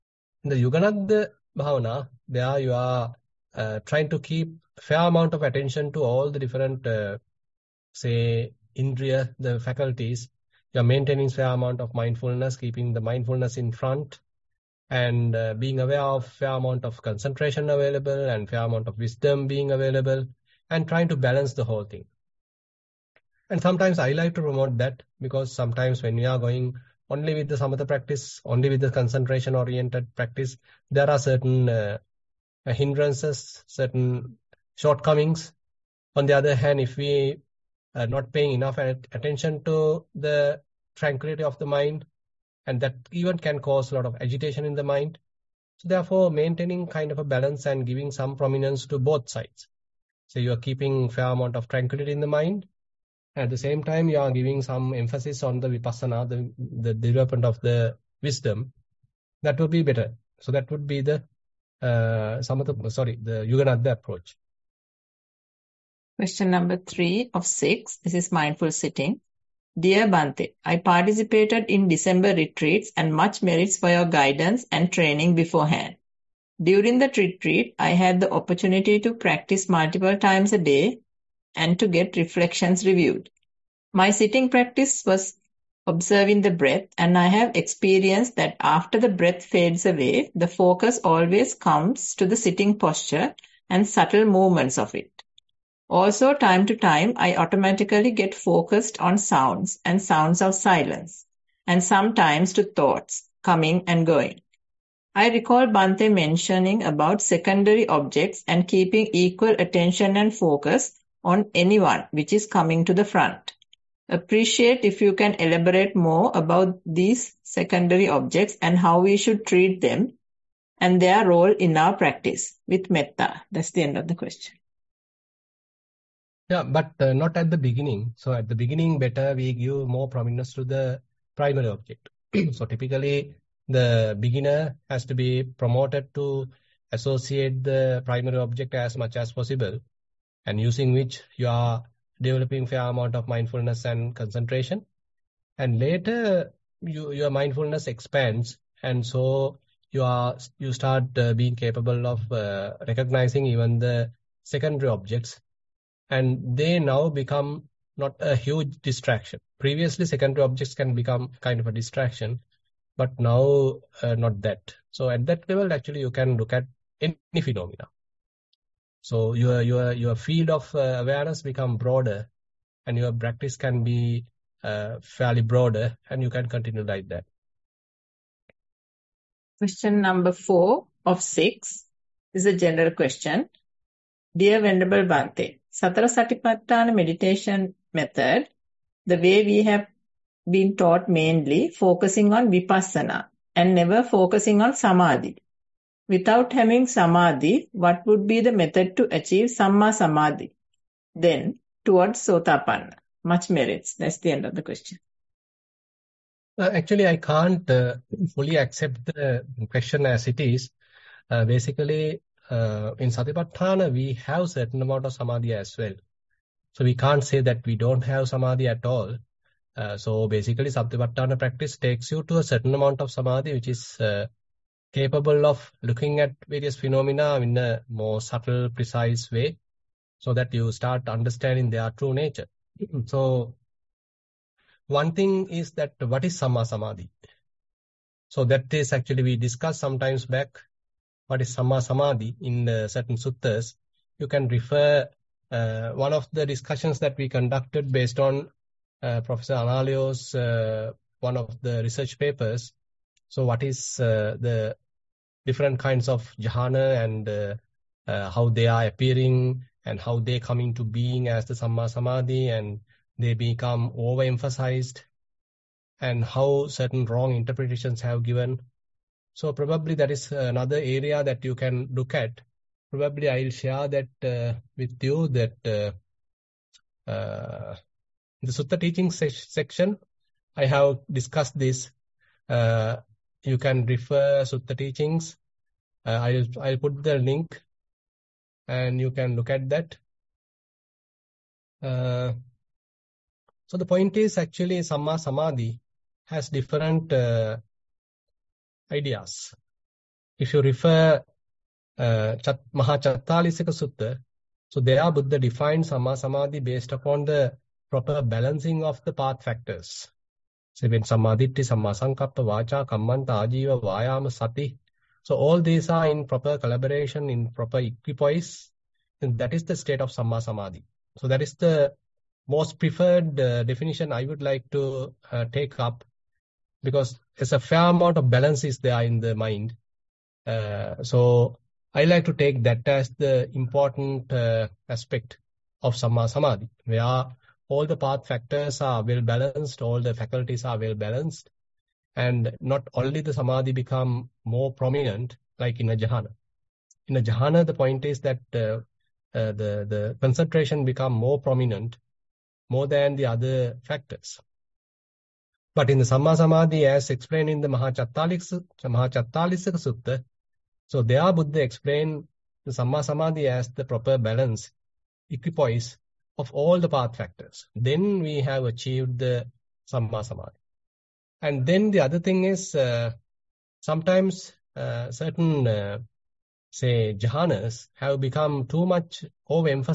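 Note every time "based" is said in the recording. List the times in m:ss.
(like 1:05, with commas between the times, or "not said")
4:07, 5:06.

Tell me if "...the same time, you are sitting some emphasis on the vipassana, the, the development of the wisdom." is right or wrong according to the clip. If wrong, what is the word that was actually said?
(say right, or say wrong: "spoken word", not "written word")
wrong: "giving", not "sitting".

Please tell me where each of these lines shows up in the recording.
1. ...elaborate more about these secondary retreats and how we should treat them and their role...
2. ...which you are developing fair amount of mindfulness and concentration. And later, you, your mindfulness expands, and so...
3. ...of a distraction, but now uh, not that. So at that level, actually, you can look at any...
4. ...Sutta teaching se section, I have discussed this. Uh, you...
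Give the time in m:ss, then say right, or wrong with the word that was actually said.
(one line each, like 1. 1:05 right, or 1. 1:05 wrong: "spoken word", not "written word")
1. 1:55 wrong: "objects", not "retreats"
2. 2:20 right
3. 2:41 right
4. 4:38 right.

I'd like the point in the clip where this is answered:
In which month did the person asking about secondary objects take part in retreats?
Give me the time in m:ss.
1:11.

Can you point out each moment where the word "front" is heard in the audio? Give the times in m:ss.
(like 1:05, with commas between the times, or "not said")
0:13, 1:53.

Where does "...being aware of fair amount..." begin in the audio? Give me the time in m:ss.
0:15.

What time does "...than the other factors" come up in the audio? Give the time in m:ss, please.
5:52.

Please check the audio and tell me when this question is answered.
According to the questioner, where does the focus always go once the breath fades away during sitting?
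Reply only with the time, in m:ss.
1:32.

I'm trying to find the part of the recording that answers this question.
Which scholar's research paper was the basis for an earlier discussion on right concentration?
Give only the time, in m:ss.
4:09.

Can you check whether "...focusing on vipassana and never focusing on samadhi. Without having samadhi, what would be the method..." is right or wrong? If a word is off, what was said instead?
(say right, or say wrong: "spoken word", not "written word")
right.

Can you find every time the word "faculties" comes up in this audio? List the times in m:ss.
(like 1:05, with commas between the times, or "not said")
0:09, 5:40.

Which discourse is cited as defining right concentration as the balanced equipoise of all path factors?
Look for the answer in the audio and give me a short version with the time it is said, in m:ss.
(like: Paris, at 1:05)
Mahachattarisaka Sutta, at 5:57.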